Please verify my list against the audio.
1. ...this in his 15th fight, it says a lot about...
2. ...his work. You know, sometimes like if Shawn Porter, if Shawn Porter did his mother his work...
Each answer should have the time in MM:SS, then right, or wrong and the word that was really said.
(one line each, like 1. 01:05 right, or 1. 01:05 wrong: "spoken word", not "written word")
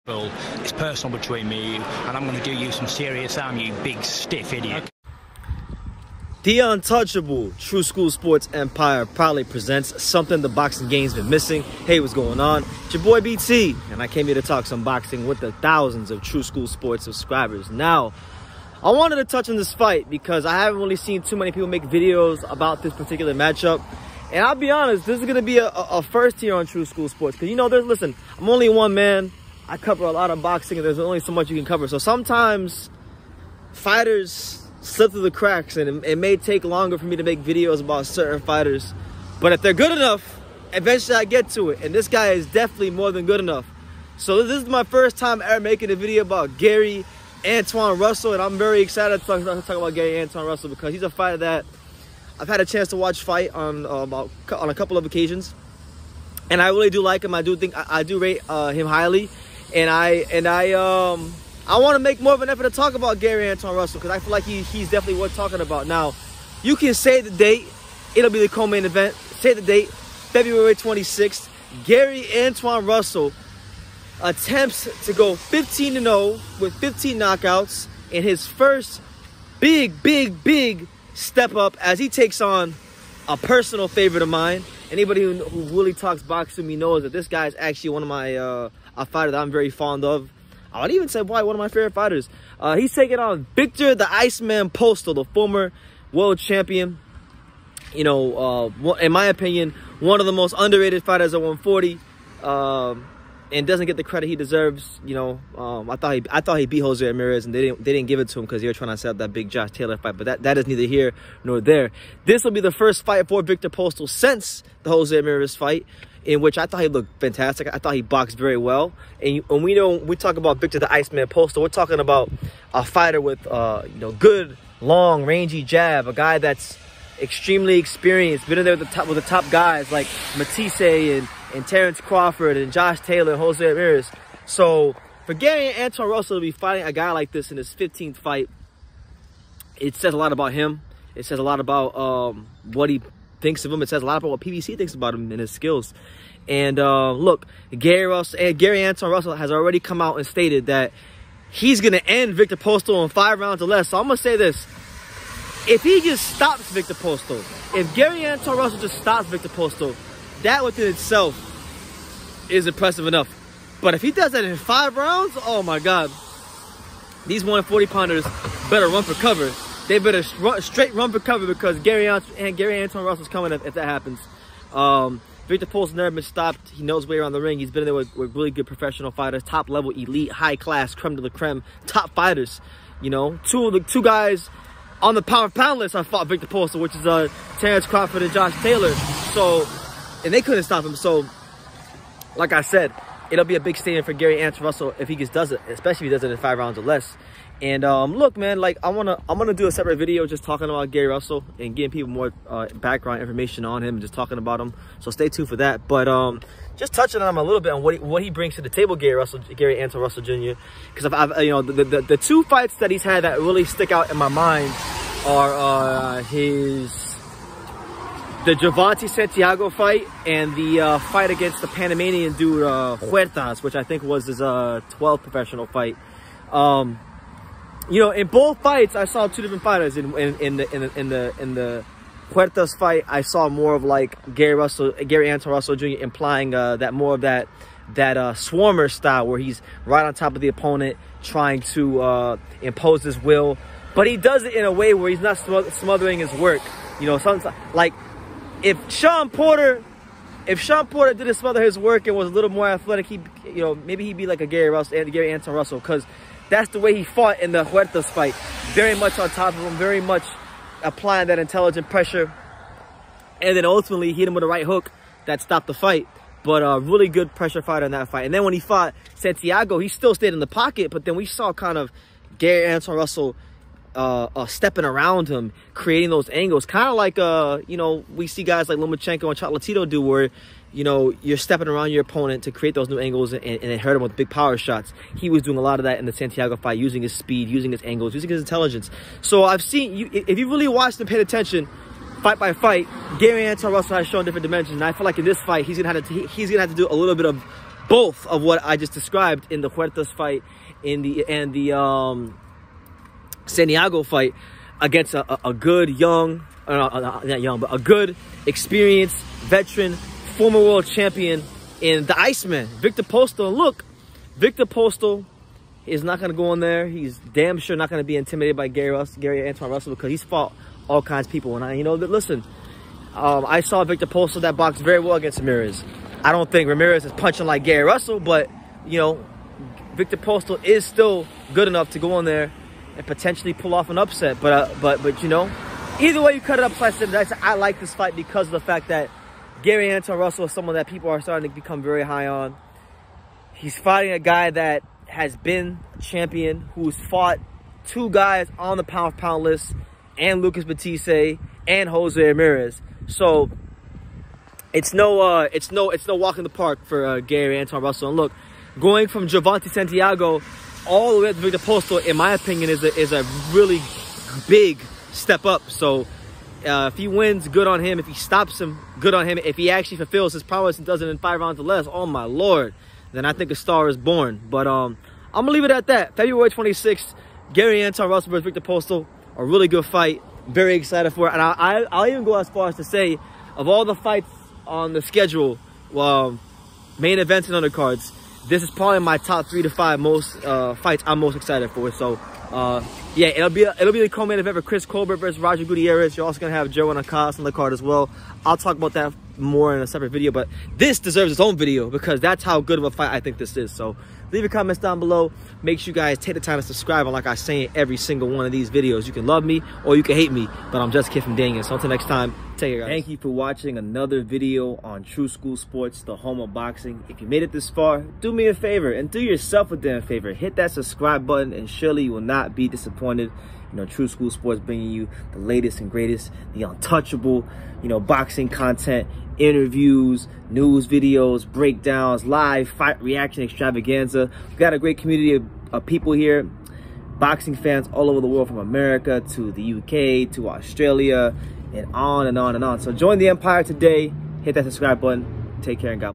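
1. 02:17 right
2. 04:06 right.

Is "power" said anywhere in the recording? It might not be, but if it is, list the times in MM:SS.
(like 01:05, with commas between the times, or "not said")
03:05, 04:44.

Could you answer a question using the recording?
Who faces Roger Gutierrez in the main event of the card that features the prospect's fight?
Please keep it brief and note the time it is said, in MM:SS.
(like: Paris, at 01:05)
Chris Colbert, at 06:34.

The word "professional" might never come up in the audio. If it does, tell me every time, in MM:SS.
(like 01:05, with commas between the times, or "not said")
02:58, 03:45.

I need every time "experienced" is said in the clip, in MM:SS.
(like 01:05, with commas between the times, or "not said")
02:07, 05:08.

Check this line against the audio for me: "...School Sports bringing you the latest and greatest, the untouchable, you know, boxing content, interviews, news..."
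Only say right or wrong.
right.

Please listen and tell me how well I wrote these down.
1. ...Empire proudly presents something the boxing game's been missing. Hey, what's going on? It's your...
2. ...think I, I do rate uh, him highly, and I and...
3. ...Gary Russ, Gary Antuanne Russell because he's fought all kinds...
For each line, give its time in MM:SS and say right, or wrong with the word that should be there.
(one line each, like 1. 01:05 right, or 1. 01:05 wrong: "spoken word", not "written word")
1. 00:08 right
2. 00:57 right
3. 05:18 right.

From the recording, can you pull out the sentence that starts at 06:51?
So until next time, take care, guys.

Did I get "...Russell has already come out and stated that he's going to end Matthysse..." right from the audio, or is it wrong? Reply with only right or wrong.
wrong.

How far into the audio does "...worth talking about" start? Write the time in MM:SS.
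01:05.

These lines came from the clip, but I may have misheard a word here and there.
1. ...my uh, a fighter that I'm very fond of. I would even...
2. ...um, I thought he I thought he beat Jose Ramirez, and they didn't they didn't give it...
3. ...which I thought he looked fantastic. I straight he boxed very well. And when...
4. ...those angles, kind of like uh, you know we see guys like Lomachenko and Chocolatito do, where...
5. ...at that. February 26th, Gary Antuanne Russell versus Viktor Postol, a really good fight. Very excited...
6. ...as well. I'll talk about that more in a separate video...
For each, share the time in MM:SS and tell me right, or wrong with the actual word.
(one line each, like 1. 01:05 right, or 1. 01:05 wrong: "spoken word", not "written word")
1. 01:28 right
2. 01:45 right
3. 01:56 wrong: "thought", not "straight"
4. 04:36 right
5. 06:15 right
6. 06:37 right.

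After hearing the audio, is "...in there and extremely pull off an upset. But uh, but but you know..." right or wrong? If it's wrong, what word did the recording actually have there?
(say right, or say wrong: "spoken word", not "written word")
wrong: "potentially", not "extremely".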